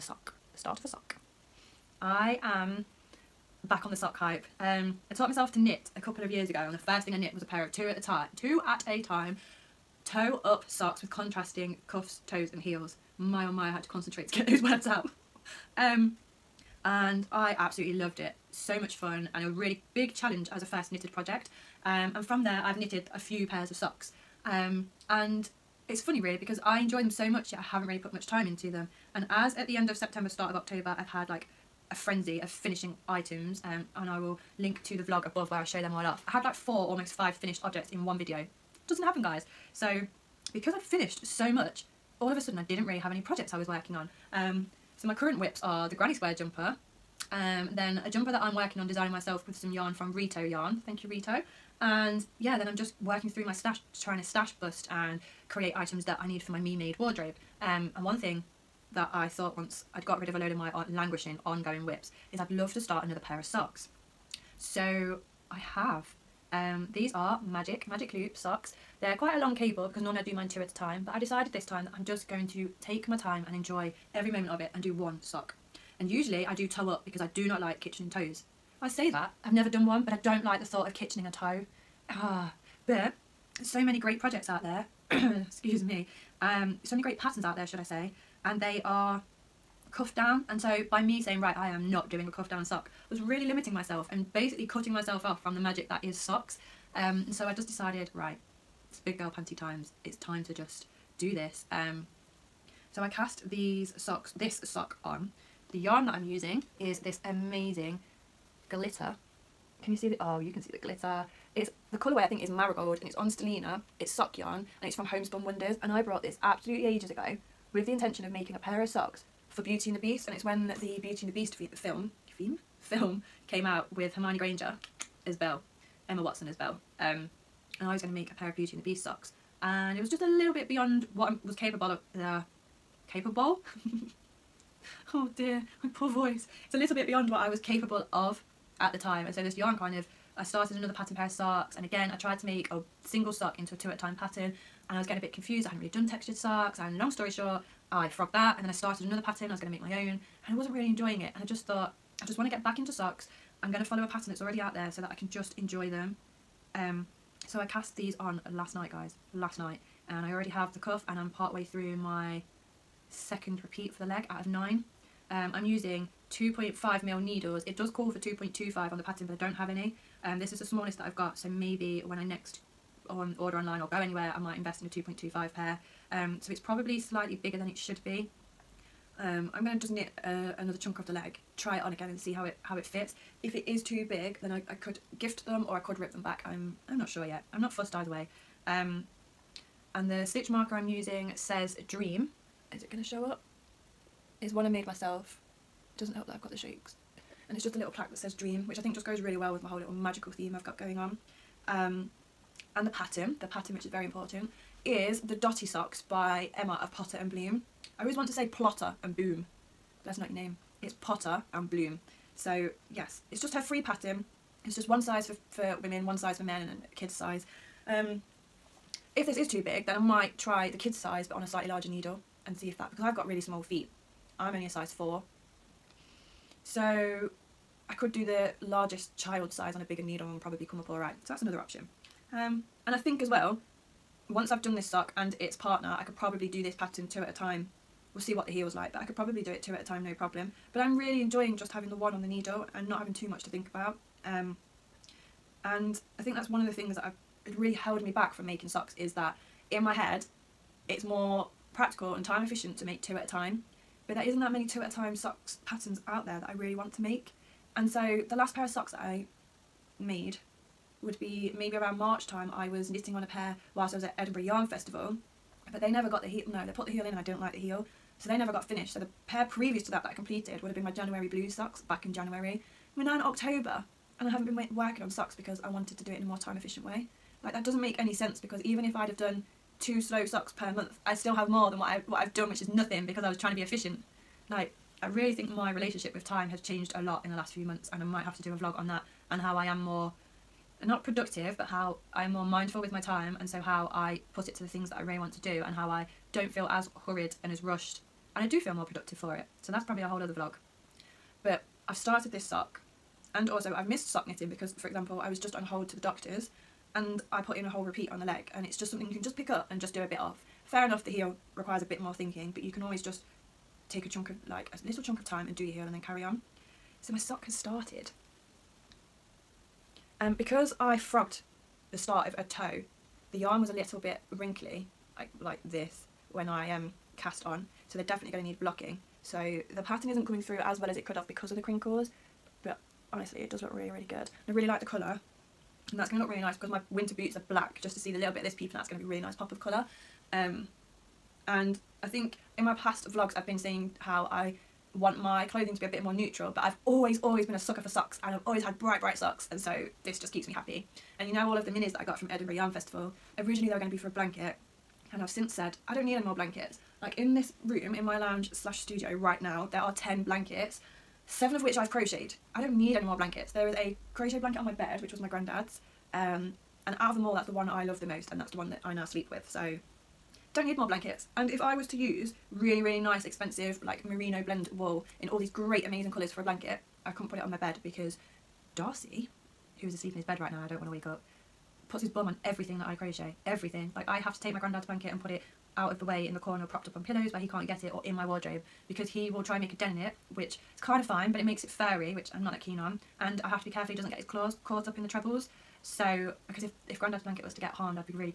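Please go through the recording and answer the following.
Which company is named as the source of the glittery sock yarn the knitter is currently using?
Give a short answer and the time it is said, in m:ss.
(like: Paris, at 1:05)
Homespun Wonders, at 1:55.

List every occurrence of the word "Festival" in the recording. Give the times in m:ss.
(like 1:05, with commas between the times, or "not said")
4:24, 5:52.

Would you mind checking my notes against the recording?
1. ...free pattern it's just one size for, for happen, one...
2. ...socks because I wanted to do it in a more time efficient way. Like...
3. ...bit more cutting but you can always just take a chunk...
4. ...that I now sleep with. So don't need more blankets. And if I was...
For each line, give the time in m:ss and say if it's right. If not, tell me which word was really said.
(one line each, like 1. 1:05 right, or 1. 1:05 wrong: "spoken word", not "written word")
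1. 3:33 wrong: "women", not "happen"
2. 4:35 right
3. 5:11 wrong: "thinking", not "cutting"
4. 6:08 right.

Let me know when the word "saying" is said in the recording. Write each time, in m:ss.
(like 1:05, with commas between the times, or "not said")
1:31, 5:43.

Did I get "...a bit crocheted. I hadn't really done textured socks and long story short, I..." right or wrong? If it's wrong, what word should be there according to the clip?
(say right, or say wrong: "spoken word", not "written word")
wrong: "confused", not "crocheted".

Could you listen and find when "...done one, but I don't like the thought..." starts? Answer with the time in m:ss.
1:19.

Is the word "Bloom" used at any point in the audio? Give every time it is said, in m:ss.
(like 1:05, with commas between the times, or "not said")
3:27, 3:31.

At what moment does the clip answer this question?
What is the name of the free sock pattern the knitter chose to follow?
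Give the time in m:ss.
3:25.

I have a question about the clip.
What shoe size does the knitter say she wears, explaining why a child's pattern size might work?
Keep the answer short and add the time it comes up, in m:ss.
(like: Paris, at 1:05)
4, at 3:44.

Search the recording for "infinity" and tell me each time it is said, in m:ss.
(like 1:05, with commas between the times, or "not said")
not said.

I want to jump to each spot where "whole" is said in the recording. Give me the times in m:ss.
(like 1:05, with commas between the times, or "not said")
3:19, 5:00, 5:07.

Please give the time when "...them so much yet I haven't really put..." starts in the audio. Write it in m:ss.
0:27.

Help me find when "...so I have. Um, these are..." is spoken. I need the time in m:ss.
1:04.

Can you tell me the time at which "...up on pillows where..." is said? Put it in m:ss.
6:26.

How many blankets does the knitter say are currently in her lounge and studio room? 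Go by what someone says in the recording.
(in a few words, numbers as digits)
10.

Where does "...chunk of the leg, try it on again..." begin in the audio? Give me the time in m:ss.
3:00.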